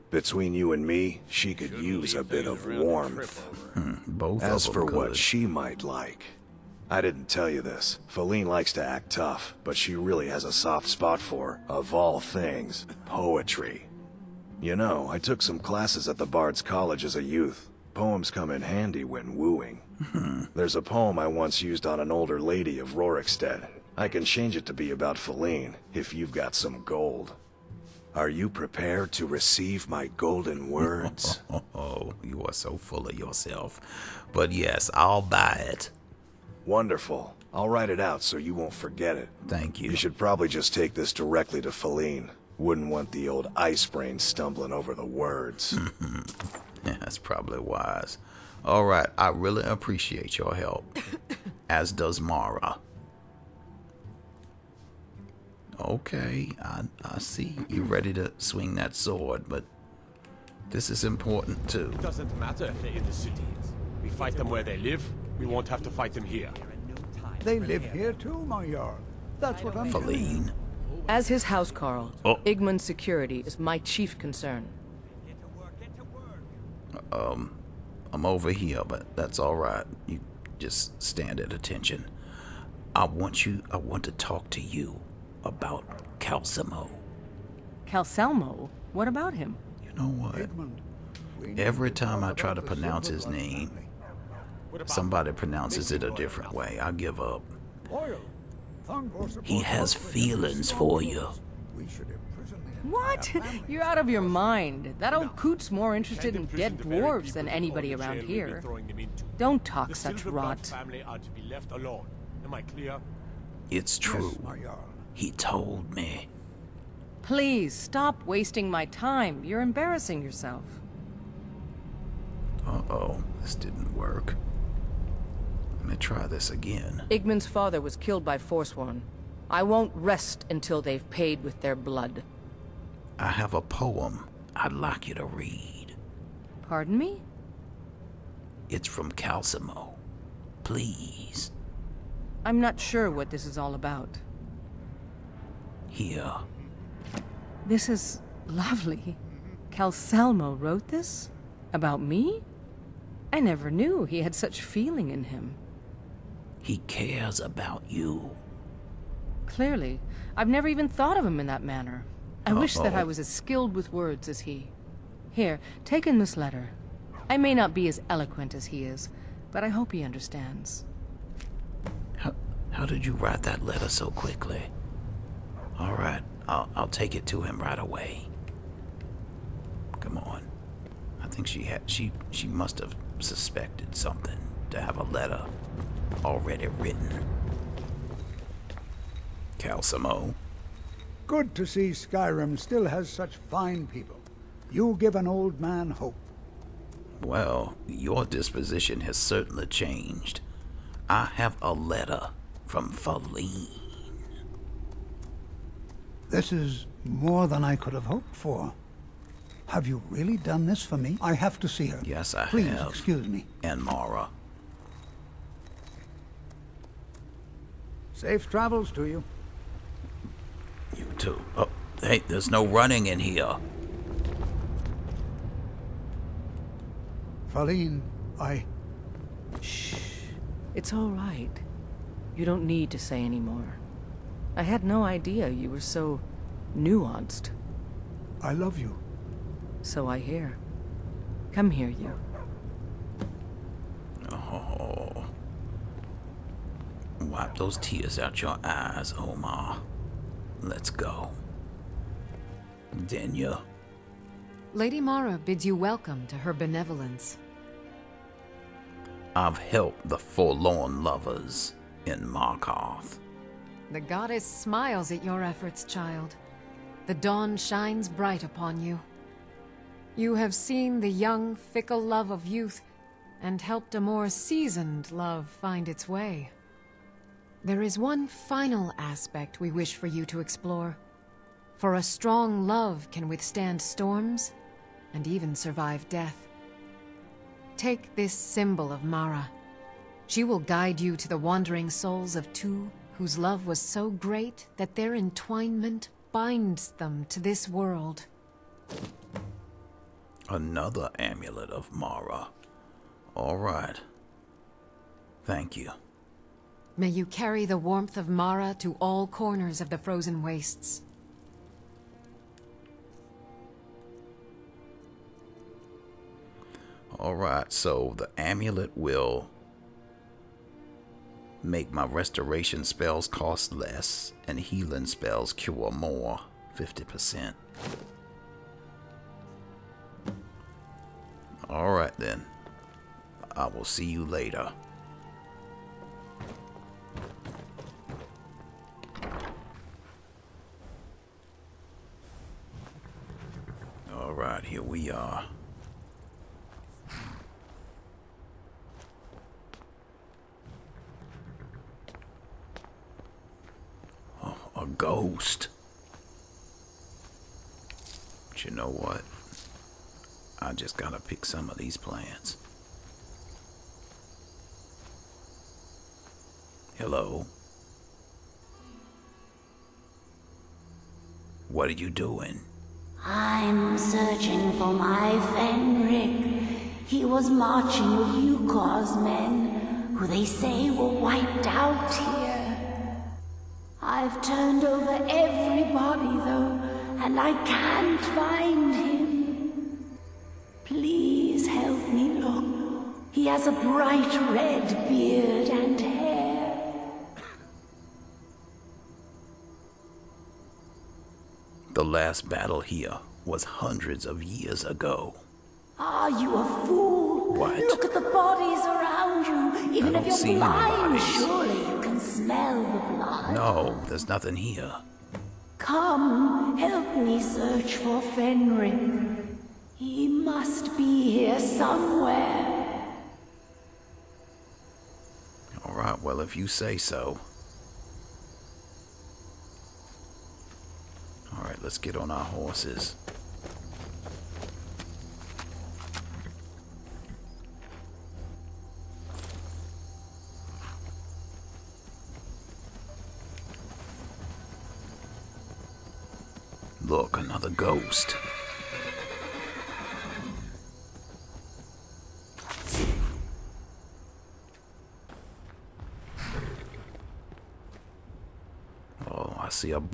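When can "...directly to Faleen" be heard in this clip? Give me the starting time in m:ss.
0:41.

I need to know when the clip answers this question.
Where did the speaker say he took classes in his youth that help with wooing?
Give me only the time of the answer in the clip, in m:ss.
0:16.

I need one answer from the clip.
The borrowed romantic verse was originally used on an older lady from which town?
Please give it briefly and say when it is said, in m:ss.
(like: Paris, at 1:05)
Rorikstead, at 0:22.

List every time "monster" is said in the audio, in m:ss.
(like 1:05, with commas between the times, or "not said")
not said.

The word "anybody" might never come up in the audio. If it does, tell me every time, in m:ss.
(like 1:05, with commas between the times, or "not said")
1:47.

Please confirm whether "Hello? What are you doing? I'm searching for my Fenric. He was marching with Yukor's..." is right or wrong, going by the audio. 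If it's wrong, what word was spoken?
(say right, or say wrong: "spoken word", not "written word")
right.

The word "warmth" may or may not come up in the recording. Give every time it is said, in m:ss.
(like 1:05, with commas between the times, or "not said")
0:02, 5:07.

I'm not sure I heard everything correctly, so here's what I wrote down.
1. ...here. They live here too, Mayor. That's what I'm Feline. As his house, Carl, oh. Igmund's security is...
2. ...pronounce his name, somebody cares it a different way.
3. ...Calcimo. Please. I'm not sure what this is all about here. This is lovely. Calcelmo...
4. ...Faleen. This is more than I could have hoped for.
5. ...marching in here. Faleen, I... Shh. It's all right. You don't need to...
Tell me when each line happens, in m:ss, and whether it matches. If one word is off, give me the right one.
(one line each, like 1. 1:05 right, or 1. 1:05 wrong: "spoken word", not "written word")
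1. 1:06 right
2. 1:32 wrong: "pronounces", not "cares"
3. 2:19 right
4. 3:22 right
5. 3:42 wrong: "running", not "marching".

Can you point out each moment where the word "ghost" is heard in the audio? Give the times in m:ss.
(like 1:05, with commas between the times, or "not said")
5:54, 7:27.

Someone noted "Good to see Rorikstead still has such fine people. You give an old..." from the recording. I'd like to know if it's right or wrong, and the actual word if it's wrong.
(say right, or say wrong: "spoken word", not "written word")
wrong: "Skyrim", not "Rorikstead".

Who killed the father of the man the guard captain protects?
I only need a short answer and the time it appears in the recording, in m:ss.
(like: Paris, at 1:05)
Forsworn, at 2:08.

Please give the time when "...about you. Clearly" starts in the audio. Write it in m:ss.
2:37.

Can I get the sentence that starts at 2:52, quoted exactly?
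How, how did you write that letter so quickly?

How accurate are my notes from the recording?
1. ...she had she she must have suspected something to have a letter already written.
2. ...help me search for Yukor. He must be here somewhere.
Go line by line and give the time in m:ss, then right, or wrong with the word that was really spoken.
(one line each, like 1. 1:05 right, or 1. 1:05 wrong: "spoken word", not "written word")
1. 3:01 right
2. 6:56 wrong: "Fenrir", not "Yukor".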